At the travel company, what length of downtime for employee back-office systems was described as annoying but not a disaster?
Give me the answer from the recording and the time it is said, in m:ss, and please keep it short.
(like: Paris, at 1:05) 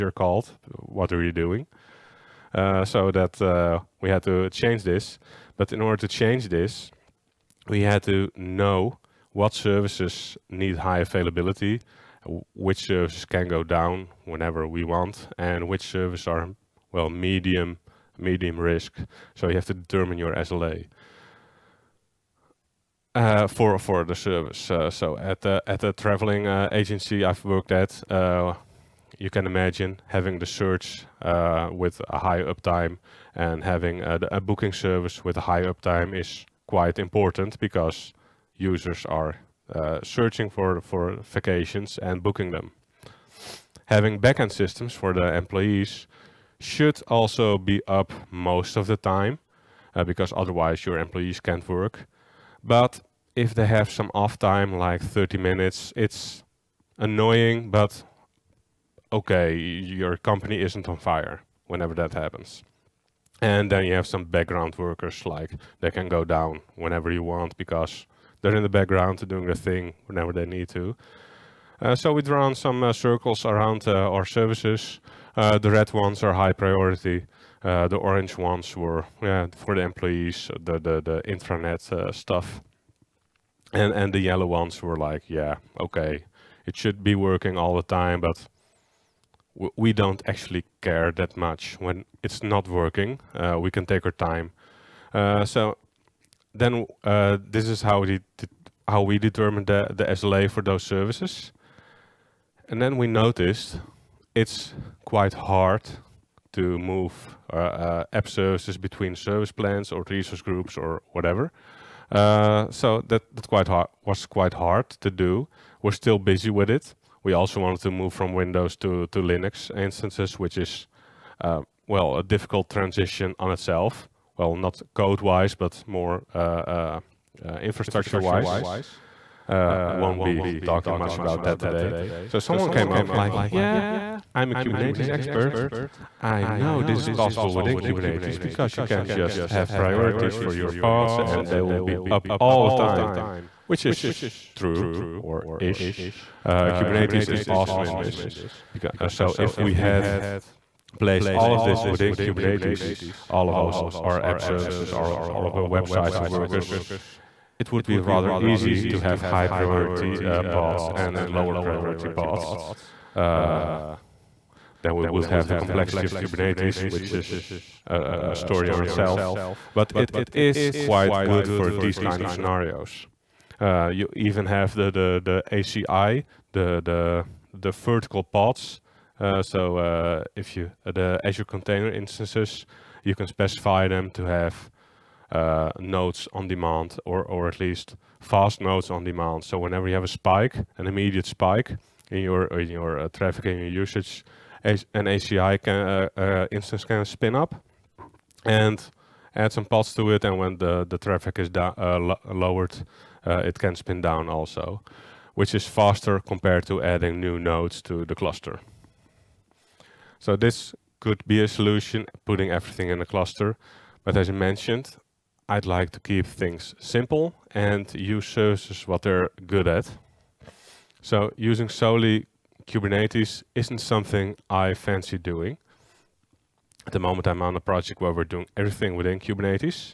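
30 minutes, at 0:55.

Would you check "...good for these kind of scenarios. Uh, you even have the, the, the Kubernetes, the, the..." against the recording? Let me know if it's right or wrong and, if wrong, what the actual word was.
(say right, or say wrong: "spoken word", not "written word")
wrong: "ACI", not "Kubernetes".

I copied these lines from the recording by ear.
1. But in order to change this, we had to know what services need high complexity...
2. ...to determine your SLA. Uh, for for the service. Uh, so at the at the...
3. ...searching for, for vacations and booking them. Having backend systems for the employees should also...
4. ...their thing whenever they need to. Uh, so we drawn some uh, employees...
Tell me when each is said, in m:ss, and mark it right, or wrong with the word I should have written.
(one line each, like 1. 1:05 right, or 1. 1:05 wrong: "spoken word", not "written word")
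1. 0:05 wrong: "availability", not "complexity"
2. 0:19 right
3. 0:40 right
4. 1:09 wrong: "circles", not "employees".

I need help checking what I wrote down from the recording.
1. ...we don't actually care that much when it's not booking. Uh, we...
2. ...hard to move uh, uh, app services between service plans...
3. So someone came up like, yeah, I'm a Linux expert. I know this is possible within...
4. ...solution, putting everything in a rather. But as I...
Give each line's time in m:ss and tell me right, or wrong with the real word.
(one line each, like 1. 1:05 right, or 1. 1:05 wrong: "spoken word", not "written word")
1. 1:29 wrong: "working", not "booking"
2. 1:45 right
3. 2:12 wrong: "Kubernetes", not "Linux"
4. 3:31 wrong: "cluster", not "rather".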